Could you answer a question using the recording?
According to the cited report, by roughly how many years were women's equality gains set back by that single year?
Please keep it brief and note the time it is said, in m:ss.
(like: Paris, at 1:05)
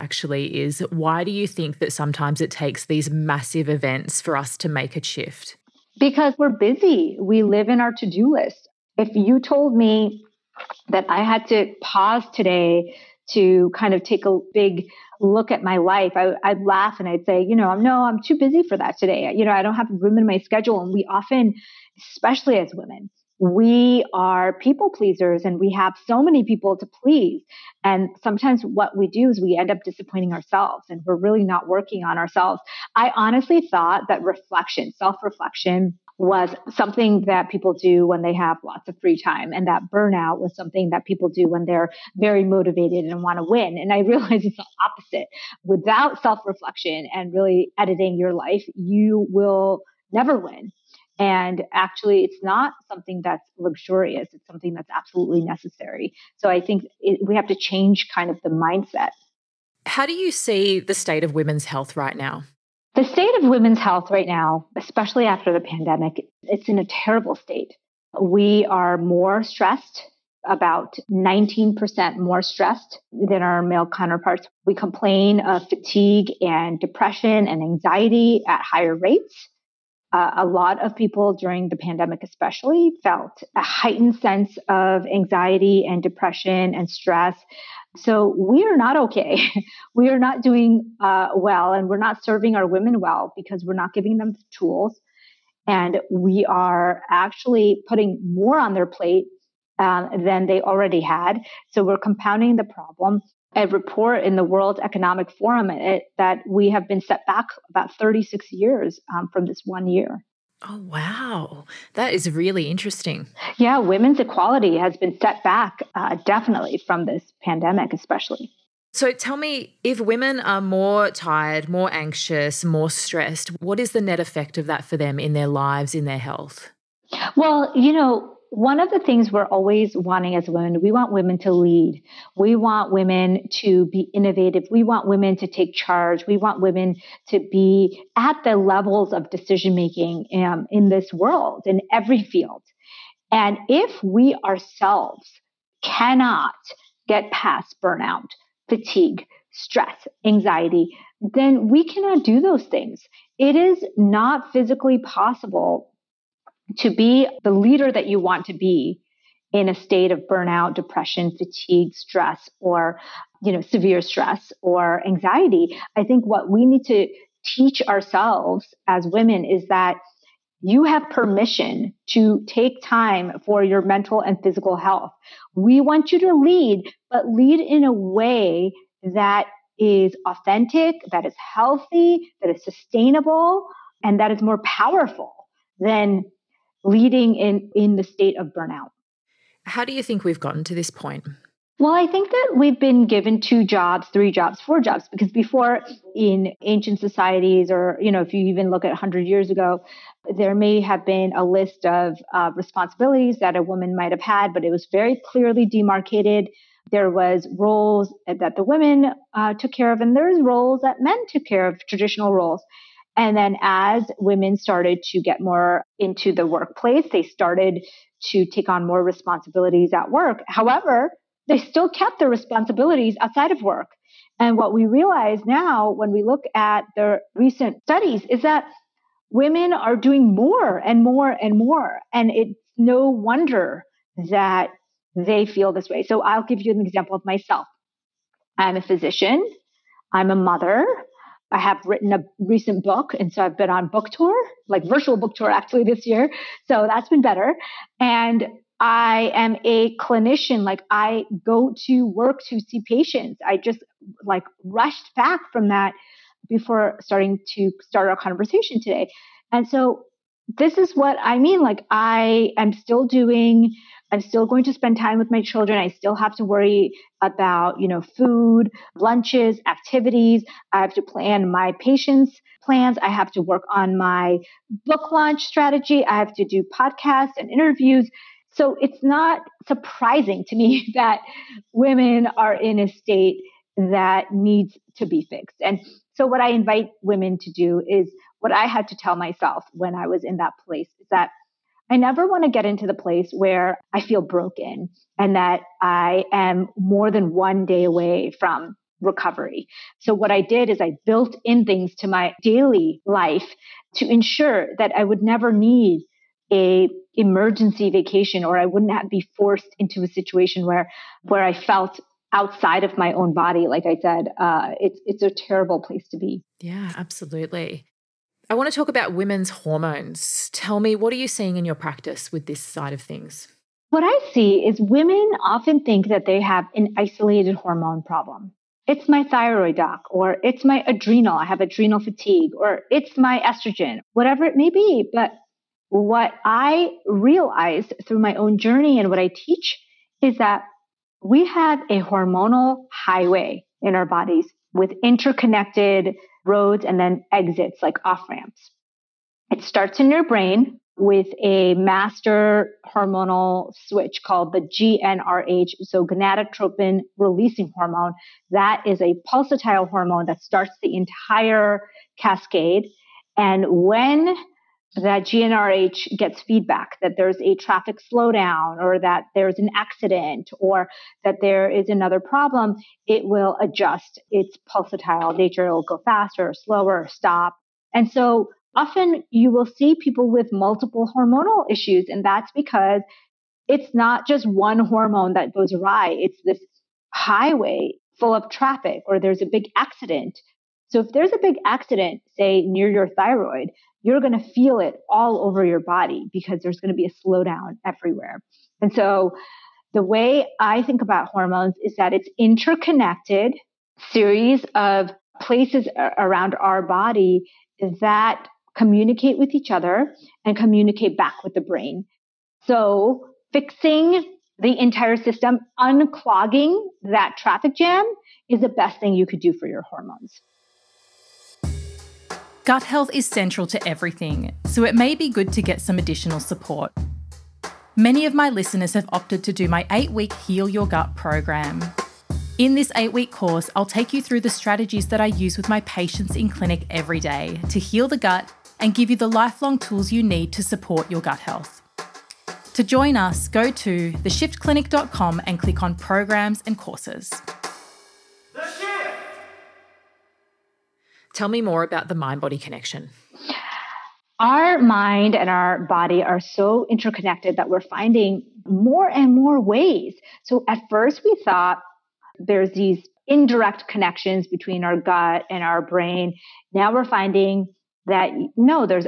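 36, at 1:47.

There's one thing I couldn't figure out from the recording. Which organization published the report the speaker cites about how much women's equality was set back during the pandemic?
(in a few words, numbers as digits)
World Economic Forum.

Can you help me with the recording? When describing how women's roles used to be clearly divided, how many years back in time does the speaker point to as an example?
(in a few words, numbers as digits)
100.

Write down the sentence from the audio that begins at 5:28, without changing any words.
It's my thyroid doc, or it's my adrenal, I have adrenal fatigue, or it's my estrogen, whatever it may be.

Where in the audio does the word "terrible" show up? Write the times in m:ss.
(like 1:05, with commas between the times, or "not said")
1:06, 5:15.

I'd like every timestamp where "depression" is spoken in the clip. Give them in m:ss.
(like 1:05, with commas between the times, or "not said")
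1:16, 1:26, 2:40.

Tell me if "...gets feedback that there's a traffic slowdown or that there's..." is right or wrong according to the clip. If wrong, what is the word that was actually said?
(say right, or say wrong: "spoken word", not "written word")
right.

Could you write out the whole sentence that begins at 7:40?
So at first, we thought there's these indirect connections between our gut and our brain.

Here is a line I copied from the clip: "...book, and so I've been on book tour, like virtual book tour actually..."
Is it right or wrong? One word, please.
right.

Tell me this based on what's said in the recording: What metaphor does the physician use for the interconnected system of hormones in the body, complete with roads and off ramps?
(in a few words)
hormonal highway.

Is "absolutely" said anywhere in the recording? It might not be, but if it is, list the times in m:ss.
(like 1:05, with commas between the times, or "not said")
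0:54, 5:16.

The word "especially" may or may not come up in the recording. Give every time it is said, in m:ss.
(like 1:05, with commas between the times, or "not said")
0:22, 1:04, 1:22, 1:57.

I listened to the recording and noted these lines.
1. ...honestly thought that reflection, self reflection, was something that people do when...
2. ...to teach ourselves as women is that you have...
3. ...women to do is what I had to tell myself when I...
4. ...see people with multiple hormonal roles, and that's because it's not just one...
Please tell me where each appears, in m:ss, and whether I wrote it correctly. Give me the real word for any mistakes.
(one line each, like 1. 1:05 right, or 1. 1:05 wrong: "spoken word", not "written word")
1. 0:33 right
2. 2:46 right
3. 4:47 right
4. 6:19 wrong: "issues", not "roles".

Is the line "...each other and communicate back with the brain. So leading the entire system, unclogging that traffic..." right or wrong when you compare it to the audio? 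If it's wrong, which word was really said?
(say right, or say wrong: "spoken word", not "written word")
wrong: "fixing", not "leading".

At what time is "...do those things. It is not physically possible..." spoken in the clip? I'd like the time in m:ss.
2:32.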